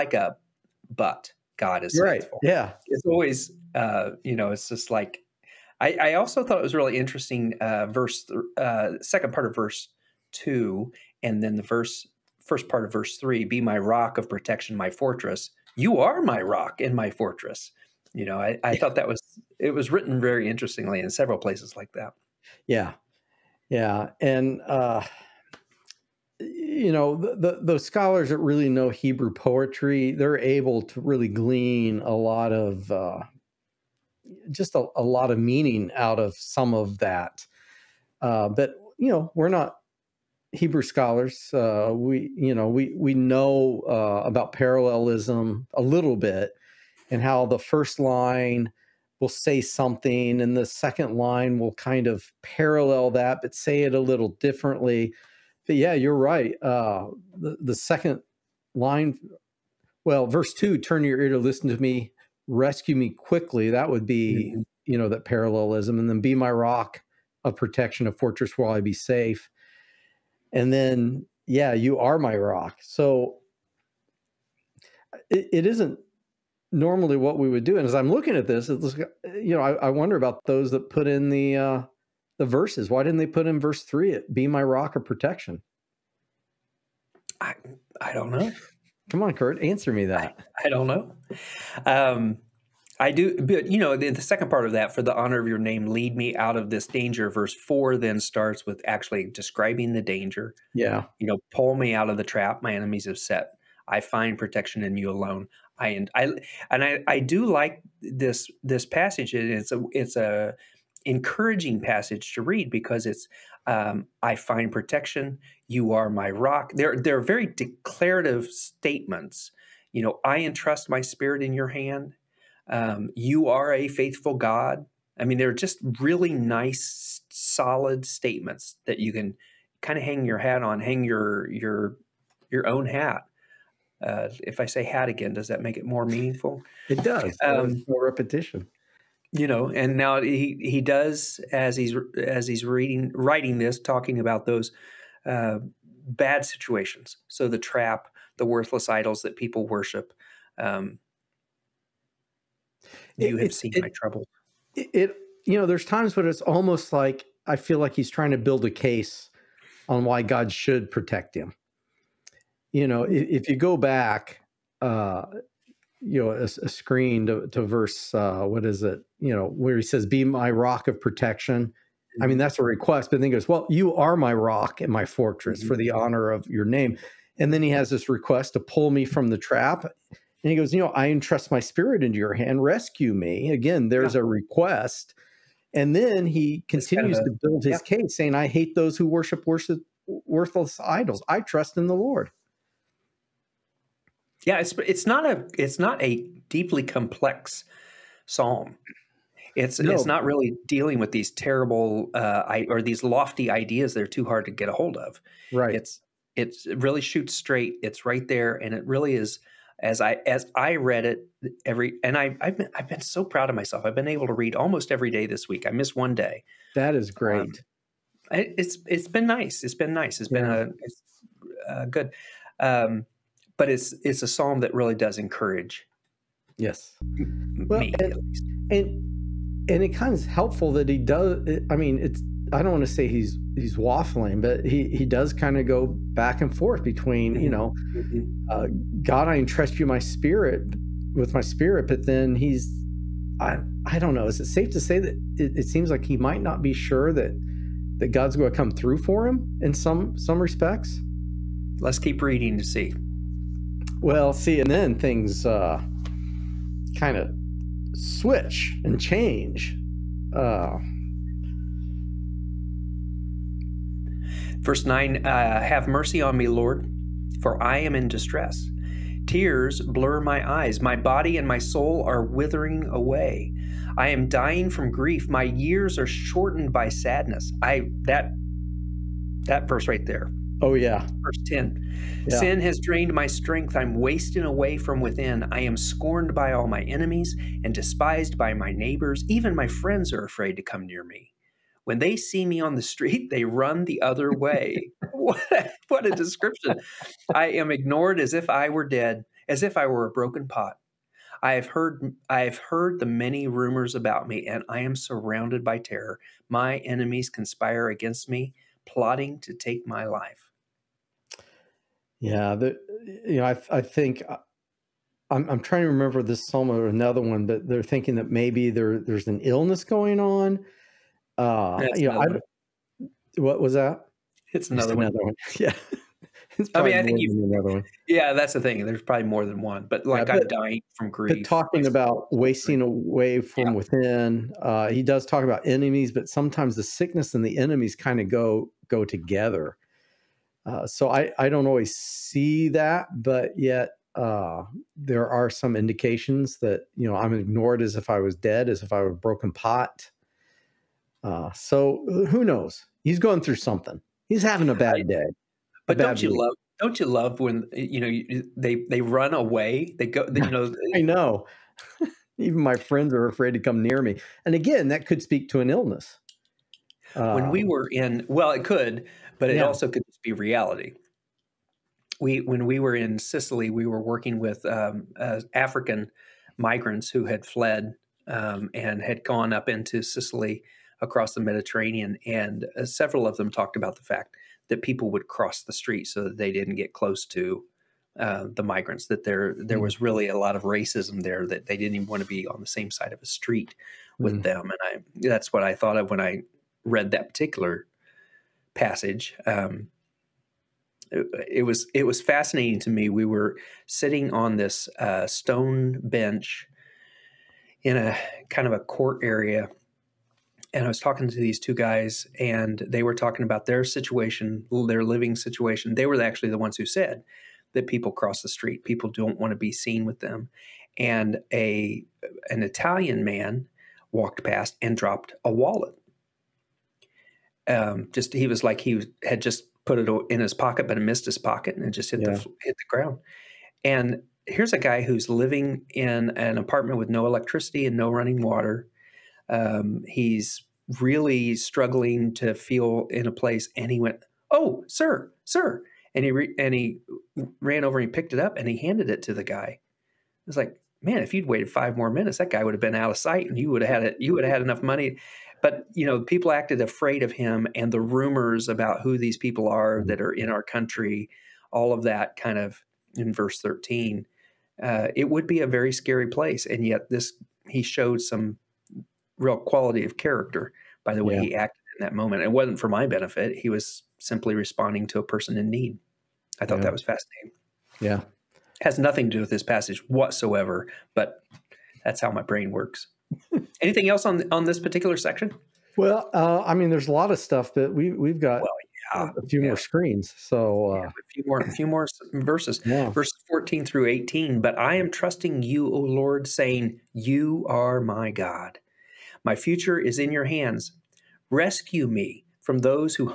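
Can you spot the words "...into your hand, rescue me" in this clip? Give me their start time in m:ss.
3:02.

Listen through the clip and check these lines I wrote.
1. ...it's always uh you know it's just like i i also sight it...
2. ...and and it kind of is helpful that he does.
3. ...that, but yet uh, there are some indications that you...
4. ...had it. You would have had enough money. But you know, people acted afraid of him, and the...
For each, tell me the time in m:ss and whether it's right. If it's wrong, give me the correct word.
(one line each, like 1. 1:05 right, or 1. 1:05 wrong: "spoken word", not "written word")
1. 0:02 wrong: "thought", not "sight"
2. 3:48 right
3. 5:42 right
4. 7:33 right.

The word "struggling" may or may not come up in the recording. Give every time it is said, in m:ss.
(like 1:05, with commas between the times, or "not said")
7:21.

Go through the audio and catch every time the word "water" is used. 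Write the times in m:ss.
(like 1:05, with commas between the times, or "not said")
7:18.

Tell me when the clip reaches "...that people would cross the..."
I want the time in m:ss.
6:24.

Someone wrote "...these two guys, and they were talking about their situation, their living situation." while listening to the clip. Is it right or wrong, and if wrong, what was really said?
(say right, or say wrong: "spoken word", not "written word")
right.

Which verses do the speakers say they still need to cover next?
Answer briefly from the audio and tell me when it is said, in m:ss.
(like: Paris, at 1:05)
14 through 18, at 8:13.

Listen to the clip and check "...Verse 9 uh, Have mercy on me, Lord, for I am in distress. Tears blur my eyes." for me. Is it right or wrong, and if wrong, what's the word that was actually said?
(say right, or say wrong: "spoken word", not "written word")
right.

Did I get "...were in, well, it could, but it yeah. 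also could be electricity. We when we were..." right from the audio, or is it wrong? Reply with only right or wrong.
wrong.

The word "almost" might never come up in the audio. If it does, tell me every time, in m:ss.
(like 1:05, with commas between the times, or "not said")
2:36, 3:34.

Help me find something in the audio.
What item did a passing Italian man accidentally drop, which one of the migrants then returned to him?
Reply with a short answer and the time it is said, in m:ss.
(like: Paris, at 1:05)
a wallet, at 7:05.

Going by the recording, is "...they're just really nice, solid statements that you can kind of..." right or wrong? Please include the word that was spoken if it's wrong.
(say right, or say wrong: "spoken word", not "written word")
right.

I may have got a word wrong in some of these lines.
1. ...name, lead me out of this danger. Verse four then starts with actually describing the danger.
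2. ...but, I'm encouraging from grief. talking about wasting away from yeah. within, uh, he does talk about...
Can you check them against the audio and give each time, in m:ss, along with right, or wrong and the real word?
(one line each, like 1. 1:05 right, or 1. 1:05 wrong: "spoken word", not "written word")
1. 1:35 right
2. 5:30 wrong: "dying", not "encouraging".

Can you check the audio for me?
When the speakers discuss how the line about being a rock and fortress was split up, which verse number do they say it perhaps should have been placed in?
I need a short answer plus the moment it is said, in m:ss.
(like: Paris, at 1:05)
verse 3, at 1:23.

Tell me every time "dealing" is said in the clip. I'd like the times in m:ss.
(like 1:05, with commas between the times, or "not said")
3:20.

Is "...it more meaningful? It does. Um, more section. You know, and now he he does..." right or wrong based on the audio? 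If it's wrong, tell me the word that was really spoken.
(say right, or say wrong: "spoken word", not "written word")
wrong: "repetition", not "section".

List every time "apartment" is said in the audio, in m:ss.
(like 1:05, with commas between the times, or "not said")
7:16.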